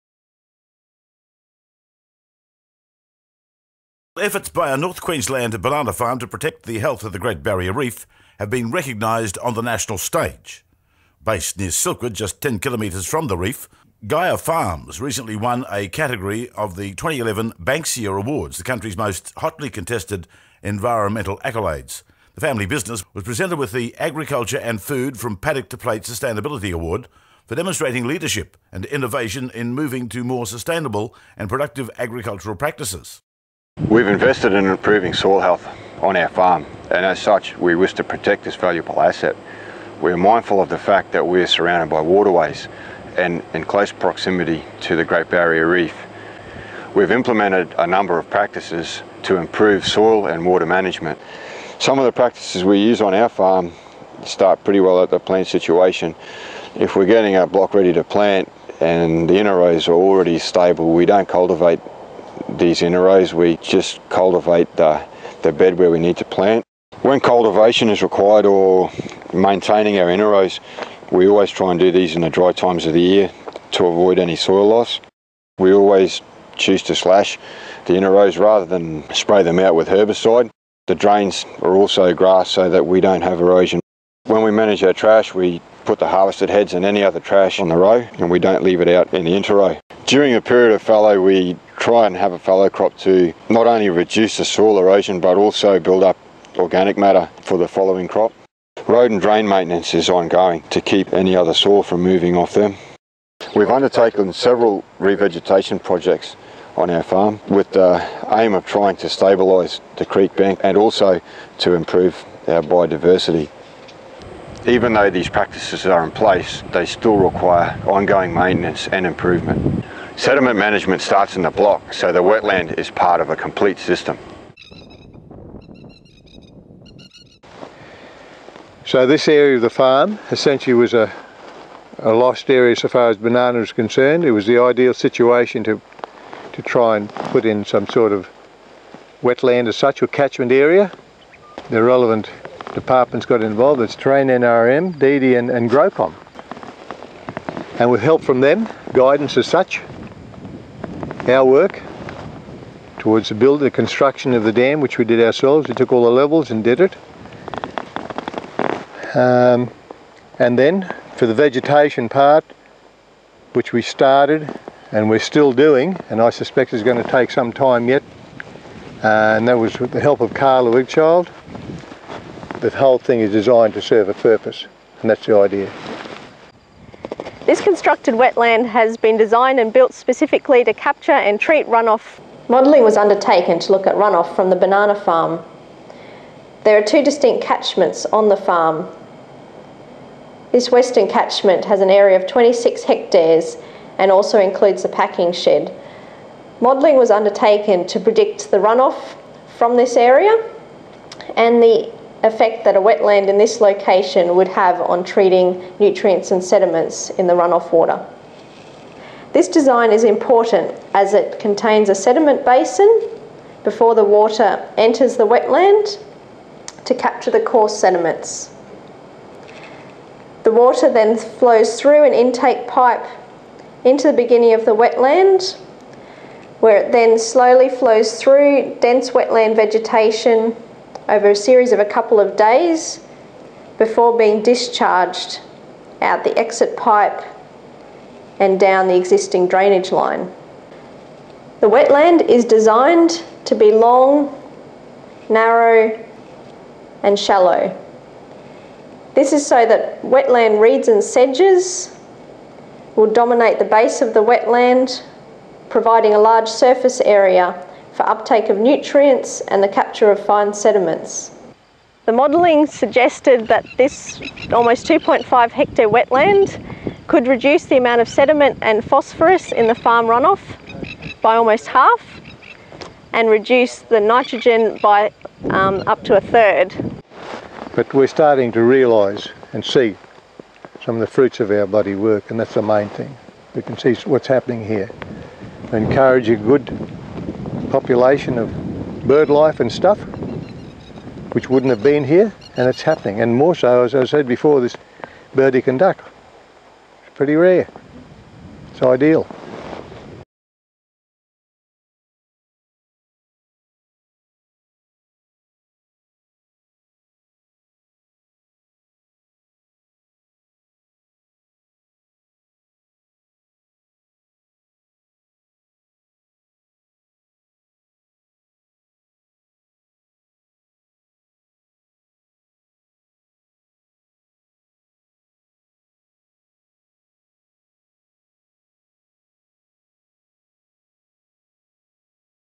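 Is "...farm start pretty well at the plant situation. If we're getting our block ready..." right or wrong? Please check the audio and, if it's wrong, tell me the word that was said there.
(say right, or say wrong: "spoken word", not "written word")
right.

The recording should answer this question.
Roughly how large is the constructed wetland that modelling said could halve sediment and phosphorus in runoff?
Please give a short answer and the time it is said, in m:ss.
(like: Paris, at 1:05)
2.5 hectares, at 4:24.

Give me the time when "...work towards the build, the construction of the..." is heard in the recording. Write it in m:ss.
2:31.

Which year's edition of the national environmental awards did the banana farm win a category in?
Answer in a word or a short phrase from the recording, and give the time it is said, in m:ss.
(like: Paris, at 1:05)
2011, at 0:16.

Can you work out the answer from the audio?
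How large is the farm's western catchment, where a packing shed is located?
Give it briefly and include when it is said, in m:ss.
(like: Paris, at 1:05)
26 hectares, at 3:12.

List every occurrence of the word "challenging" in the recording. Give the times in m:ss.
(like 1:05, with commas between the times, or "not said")
not said.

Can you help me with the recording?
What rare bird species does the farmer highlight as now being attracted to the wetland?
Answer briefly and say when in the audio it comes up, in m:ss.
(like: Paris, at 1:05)
Burdekin duck, at 4:55.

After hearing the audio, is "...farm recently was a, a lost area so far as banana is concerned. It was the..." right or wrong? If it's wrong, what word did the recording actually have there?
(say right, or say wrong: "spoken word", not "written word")
wrong: "essentially", not "recently".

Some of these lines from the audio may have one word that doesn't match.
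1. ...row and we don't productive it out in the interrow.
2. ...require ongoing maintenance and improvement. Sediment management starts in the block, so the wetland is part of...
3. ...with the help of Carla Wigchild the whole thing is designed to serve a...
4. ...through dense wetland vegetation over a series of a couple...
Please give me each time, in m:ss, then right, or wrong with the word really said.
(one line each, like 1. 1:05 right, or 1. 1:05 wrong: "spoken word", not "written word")
1. 1:27 wrong: "leave", not "productive"
2. 1:57 right
3. 2:49 right
4. 3:48 right.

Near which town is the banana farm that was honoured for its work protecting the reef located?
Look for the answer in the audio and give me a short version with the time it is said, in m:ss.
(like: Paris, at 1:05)
Silkwood, at 0:11.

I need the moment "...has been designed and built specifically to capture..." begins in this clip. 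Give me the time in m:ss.
2:58.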